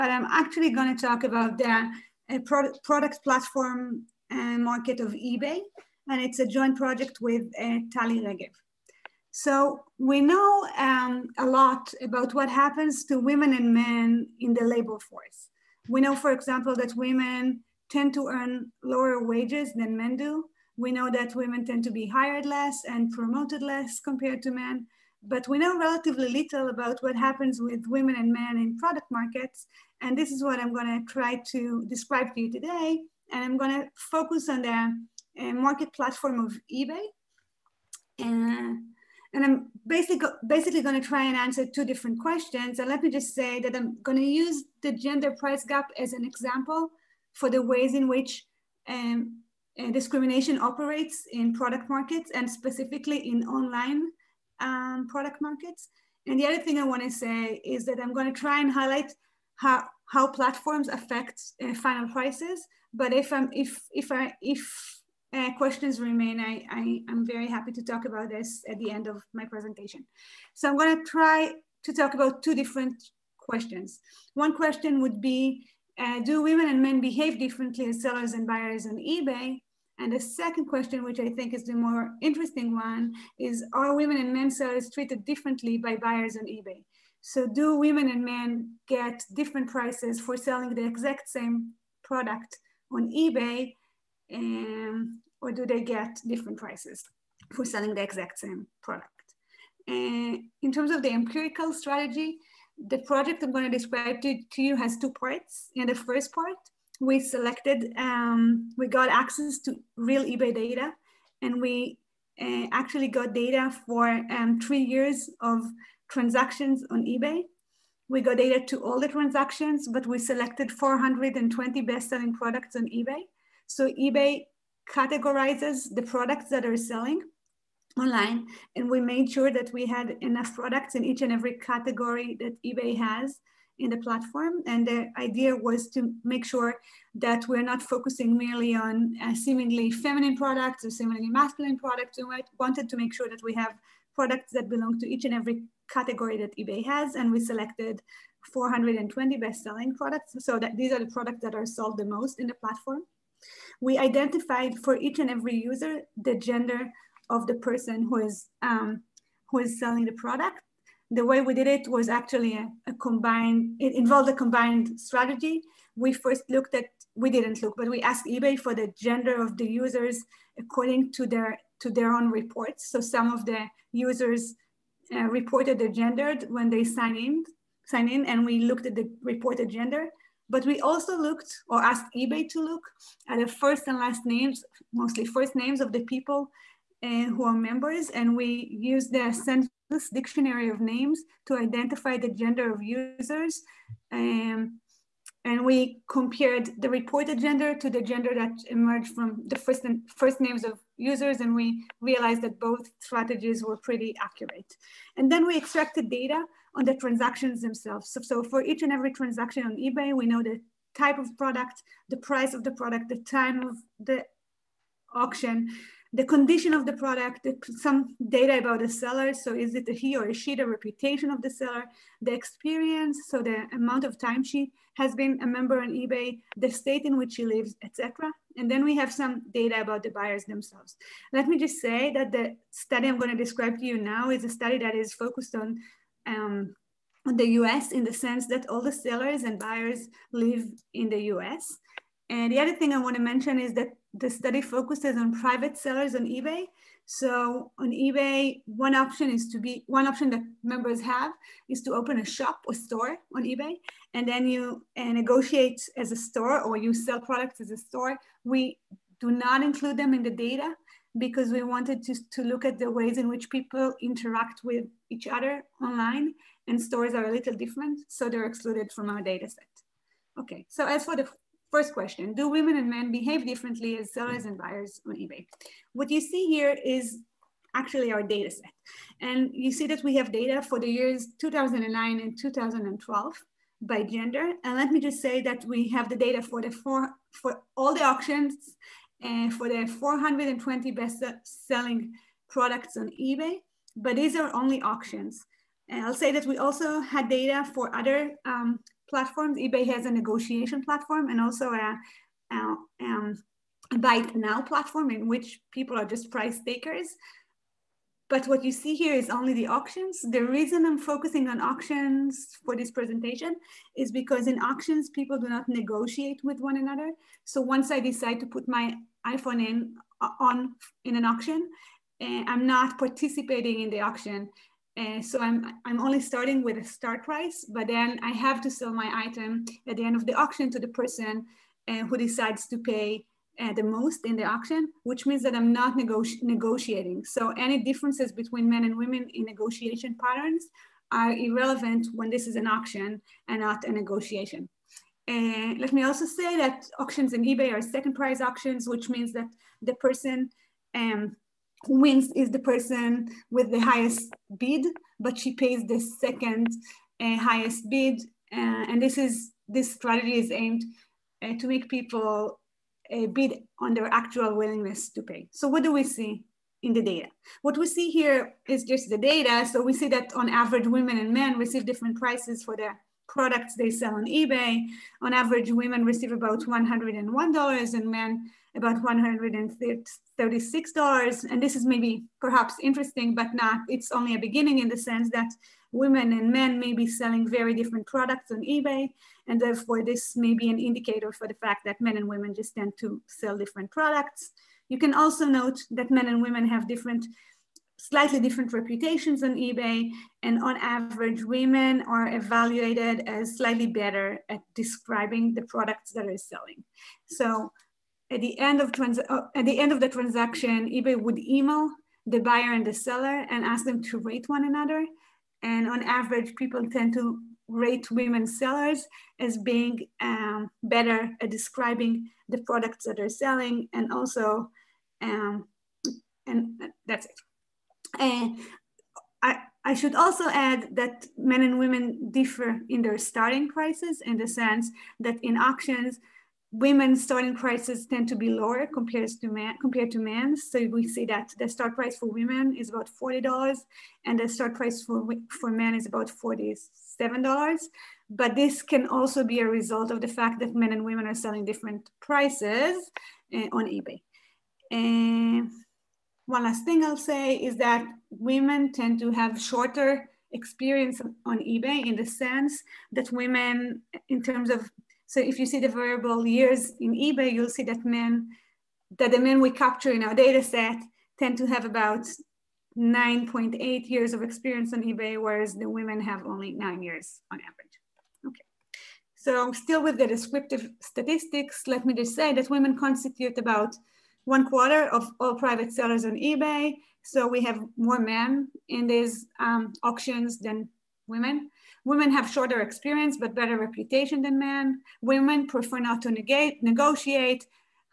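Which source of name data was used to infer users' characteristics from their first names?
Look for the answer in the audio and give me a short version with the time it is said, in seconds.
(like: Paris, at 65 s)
census, at 189 s.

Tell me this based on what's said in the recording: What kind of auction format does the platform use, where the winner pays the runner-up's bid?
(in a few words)
second price auctions.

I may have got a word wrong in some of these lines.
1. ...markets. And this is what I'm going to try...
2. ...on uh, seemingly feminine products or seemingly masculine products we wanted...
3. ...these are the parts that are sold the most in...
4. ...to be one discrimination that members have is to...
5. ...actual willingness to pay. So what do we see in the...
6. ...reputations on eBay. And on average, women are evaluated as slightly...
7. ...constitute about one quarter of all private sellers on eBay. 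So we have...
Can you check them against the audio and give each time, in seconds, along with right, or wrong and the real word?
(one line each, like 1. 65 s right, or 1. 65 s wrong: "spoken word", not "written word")
1. 29 s right
2. 138 s right
3. 150 s wrong: "products", not "parts"
4. 249 s wrong: "option", not "discrimination"
5. 364 s right
6. 398 s right
7. 482 s right.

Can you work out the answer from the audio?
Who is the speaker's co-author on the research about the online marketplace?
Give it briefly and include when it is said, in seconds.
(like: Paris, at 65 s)
Tali Regev, at 7 s.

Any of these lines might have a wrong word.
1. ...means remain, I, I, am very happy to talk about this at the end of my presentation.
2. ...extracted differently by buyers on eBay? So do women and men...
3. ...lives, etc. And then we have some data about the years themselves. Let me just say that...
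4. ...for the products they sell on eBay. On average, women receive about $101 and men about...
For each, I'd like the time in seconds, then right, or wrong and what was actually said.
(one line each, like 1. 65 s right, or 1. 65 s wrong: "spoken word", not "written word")
1. 65 s wrong: "questions", not "means"
2. 84 s wrong: "treated", not "extracted"
3. 227 s wrong: "buyers", not "years"
4. 372 s right.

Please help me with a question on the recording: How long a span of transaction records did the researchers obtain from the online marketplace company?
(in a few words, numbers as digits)
3 years.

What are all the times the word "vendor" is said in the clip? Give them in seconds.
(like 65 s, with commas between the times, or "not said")
not said.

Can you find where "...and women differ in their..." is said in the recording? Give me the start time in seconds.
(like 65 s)
431 s.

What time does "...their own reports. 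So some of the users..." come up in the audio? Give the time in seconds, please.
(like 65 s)
171 s.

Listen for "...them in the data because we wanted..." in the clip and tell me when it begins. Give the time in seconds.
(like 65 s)
259 s.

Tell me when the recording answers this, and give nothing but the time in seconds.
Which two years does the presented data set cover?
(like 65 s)
281 s.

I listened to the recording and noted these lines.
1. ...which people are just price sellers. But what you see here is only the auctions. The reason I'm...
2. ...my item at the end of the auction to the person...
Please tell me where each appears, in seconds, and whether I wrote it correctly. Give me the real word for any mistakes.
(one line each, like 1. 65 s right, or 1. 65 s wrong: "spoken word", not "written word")
1. 305 s wrong: "takers", not "sellers"
2. 328 s right.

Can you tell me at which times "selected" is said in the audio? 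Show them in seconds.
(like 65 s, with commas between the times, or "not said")
107 s, 120 s, 147 s.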